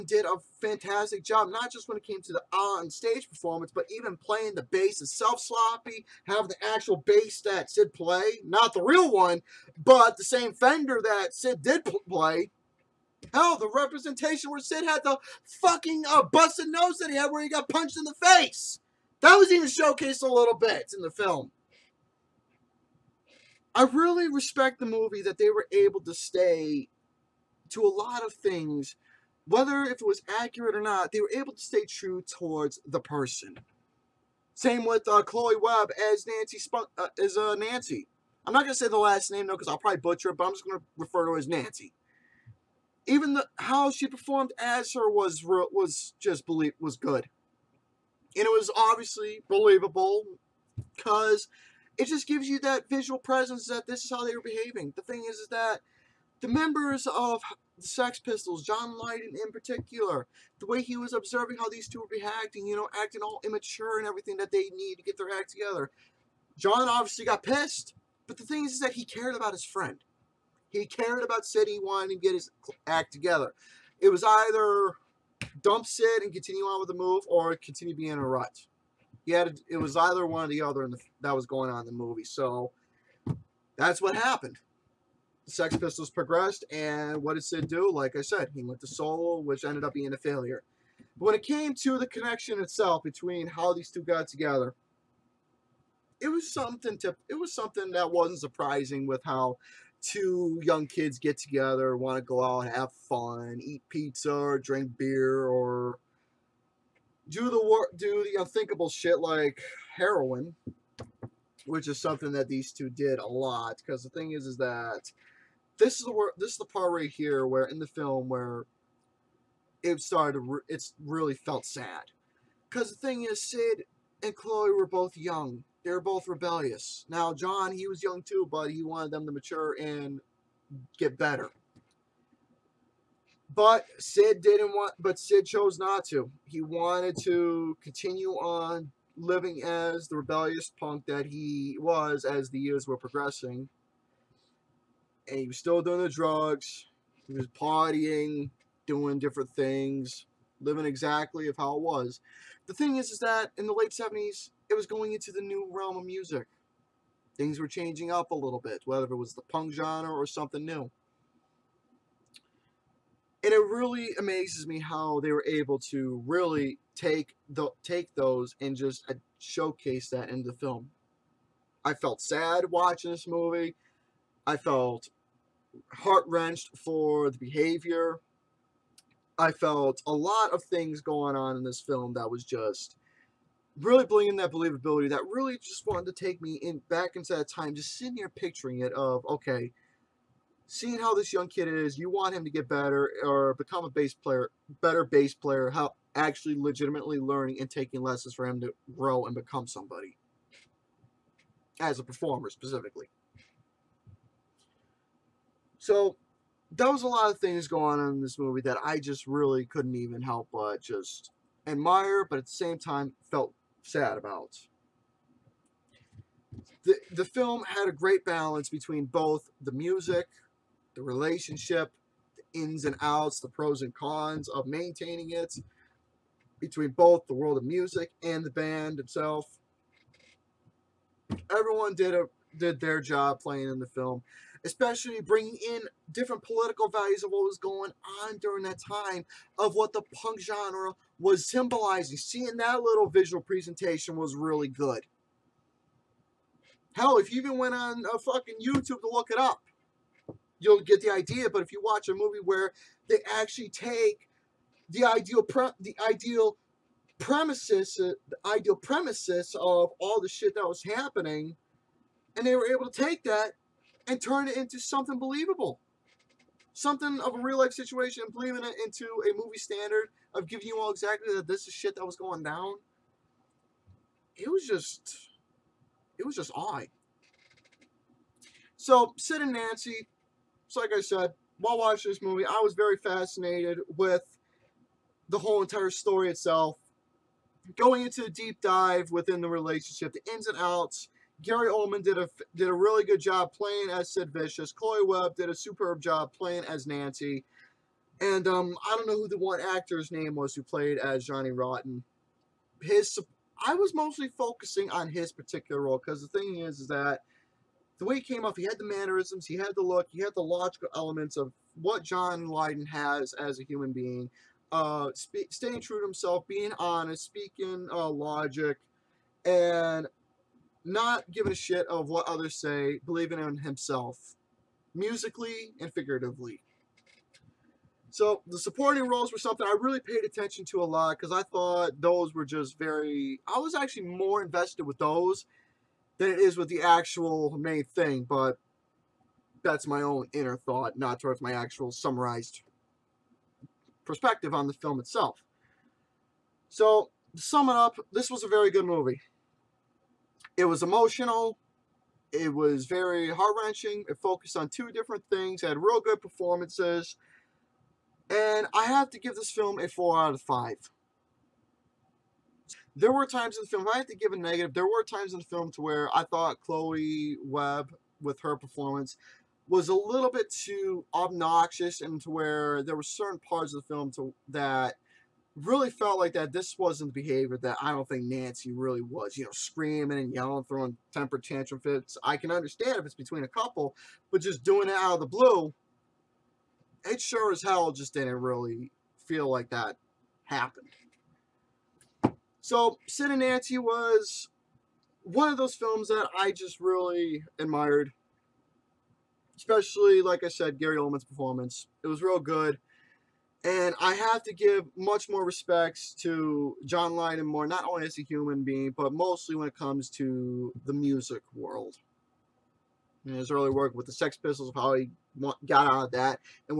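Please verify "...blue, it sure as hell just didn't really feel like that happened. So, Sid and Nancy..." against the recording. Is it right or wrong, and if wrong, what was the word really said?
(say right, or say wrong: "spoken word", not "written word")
right.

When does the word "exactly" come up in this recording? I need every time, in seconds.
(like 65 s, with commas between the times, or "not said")
150 s, 270 s.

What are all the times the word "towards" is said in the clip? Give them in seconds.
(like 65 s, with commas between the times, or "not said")
32 s, 341 s.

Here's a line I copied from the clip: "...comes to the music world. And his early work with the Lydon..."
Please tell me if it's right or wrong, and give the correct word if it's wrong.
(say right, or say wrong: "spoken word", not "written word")
wrong: "Sex", not "Lydon".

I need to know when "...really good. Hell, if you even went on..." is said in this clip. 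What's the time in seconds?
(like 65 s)
244 s.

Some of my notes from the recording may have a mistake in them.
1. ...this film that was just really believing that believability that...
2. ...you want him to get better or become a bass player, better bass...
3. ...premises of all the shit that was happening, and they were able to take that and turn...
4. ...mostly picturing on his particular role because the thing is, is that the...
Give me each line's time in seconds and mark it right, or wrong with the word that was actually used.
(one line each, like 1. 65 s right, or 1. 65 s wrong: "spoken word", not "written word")
1. 181 s wrong: "bringing", not "believing"
2. 191 s right
3. 258 s right
4. 303 s wrong: "focusing", not "picturing".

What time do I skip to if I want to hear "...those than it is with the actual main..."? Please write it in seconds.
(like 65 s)
334 s.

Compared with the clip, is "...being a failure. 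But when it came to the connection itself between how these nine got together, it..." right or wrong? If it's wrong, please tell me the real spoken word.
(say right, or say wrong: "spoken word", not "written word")
wrong: "two", not "nine".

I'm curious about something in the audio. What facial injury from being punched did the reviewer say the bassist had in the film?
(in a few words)
busted nose.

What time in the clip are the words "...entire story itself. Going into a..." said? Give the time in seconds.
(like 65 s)
285 s.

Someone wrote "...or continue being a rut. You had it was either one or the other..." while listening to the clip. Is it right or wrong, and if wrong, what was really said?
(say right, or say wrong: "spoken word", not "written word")
right.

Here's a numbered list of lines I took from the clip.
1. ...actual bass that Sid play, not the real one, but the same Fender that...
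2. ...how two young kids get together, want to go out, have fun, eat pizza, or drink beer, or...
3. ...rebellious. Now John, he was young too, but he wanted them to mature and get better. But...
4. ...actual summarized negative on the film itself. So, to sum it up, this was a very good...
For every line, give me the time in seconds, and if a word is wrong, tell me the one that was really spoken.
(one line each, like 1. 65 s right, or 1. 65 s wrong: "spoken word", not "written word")
1. 6 s right
2. 99 s right
3. 126 s right
4. 341 s wrong: "perspective", not "negative".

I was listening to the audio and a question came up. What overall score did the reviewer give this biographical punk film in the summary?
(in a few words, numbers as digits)
4 out of 5.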